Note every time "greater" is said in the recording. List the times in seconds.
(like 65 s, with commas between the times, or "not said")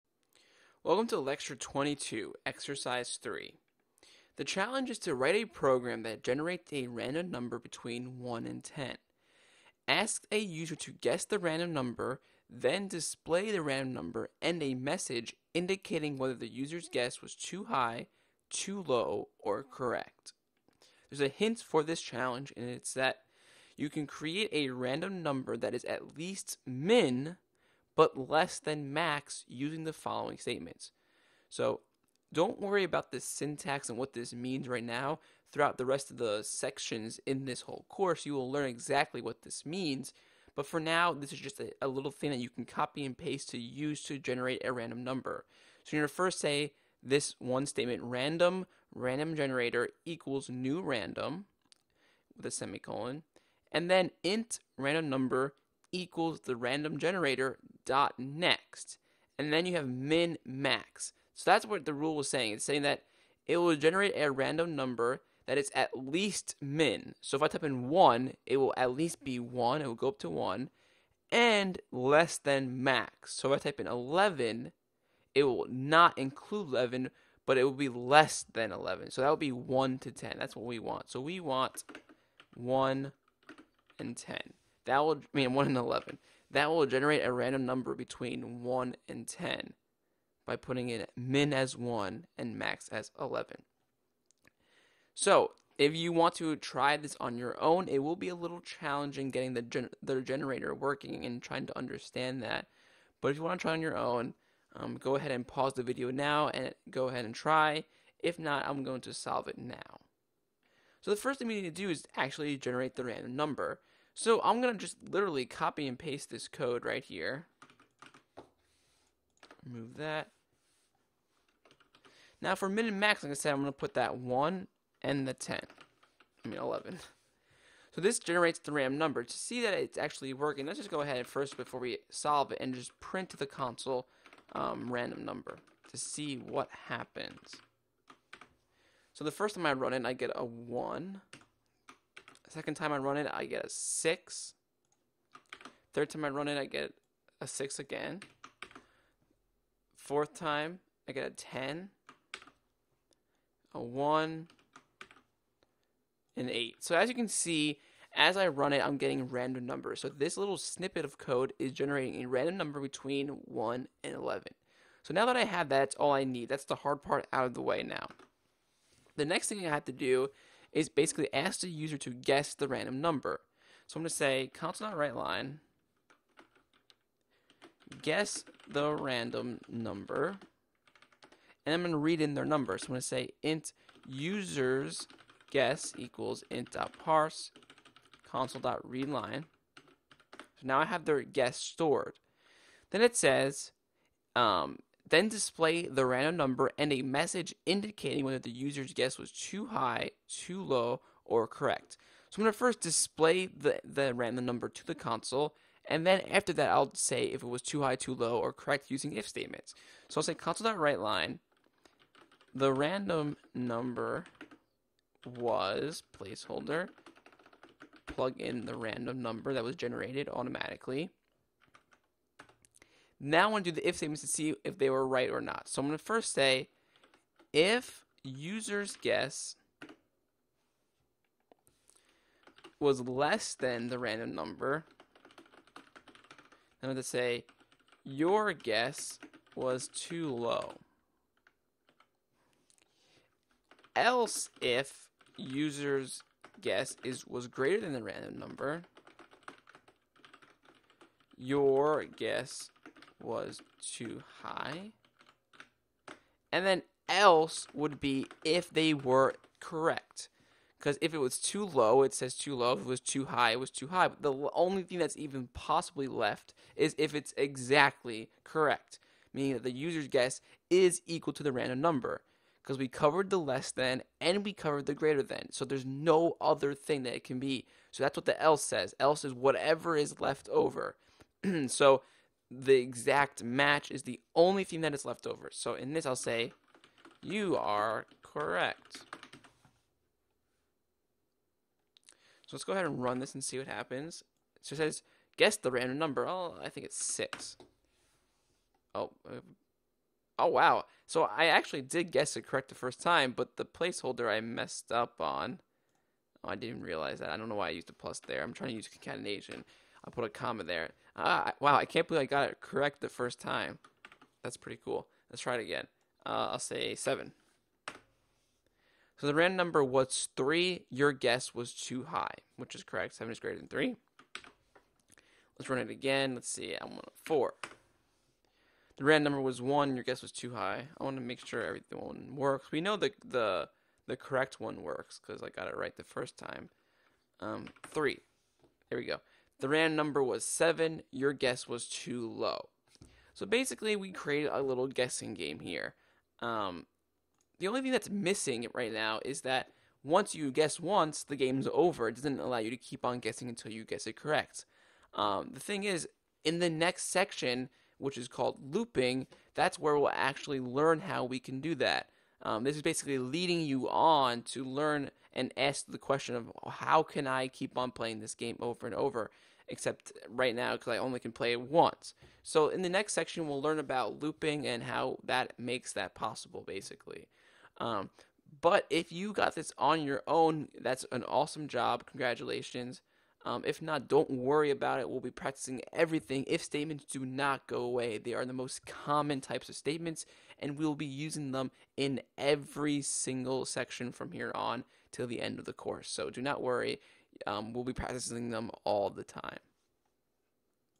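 247 s, 274 s, 323 s.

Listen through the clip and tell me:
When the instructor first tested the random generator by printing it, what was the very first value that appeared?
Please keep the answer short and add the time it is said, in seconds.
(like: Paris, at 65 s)
1, at 140 s.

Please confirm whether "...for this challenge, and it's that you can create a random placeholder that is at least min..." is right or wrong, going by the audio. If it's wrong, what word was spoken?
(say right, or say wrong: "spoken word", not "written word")
wrong: "number", not "placeholder".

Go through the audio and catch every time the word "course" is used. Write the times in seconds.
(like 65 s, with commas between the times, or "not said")
37 s, 395 s.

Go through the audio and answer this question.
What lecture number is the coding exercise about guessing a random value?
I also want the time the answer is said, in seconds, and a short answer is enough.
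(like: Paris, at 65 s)
22, at 1 s.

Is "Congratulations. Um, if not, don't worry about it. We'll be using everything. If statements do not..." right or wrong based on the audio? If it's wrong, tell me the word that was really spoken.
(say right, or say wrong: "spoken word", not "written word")
wrong: "practicing", not "using".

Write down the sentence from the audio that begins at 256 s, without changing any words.
And then else would be if they were correct.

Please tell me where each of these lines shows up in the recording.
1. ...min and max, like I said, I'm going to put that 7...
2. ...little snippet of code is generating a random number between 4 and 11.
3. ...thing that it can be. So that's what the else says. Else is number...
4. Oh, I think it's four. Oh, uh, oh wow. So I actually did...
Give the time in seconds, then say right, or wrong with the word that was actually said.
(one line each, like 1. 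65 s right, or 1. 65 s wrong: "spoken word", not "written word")
1. 122 s wrong: "1", not "7"
2. 160 s wrong: "1", not "4"
3. 276 s wrong: "whatever", not "number"
4. 296 s wrong: "six", not "four".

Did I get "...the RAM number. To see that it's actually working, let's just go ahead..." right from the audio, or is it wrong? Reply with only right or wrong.
right.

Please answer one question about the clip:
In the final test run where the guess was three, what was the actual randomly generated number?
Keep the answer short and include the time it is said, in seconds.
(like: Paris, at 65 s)
7, at 340 s.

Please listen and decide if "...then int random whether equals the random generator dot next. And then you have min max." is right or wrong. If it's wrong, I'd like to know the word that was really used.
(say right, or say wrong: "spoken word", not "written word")
wrong: "number", not "whether".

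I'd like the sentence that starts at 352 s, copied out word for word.
It doesn't allow you to keep on guessing until you guess it correct.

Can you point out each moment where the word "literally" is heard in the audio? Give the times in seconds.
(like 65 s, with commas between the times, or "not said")
115 s.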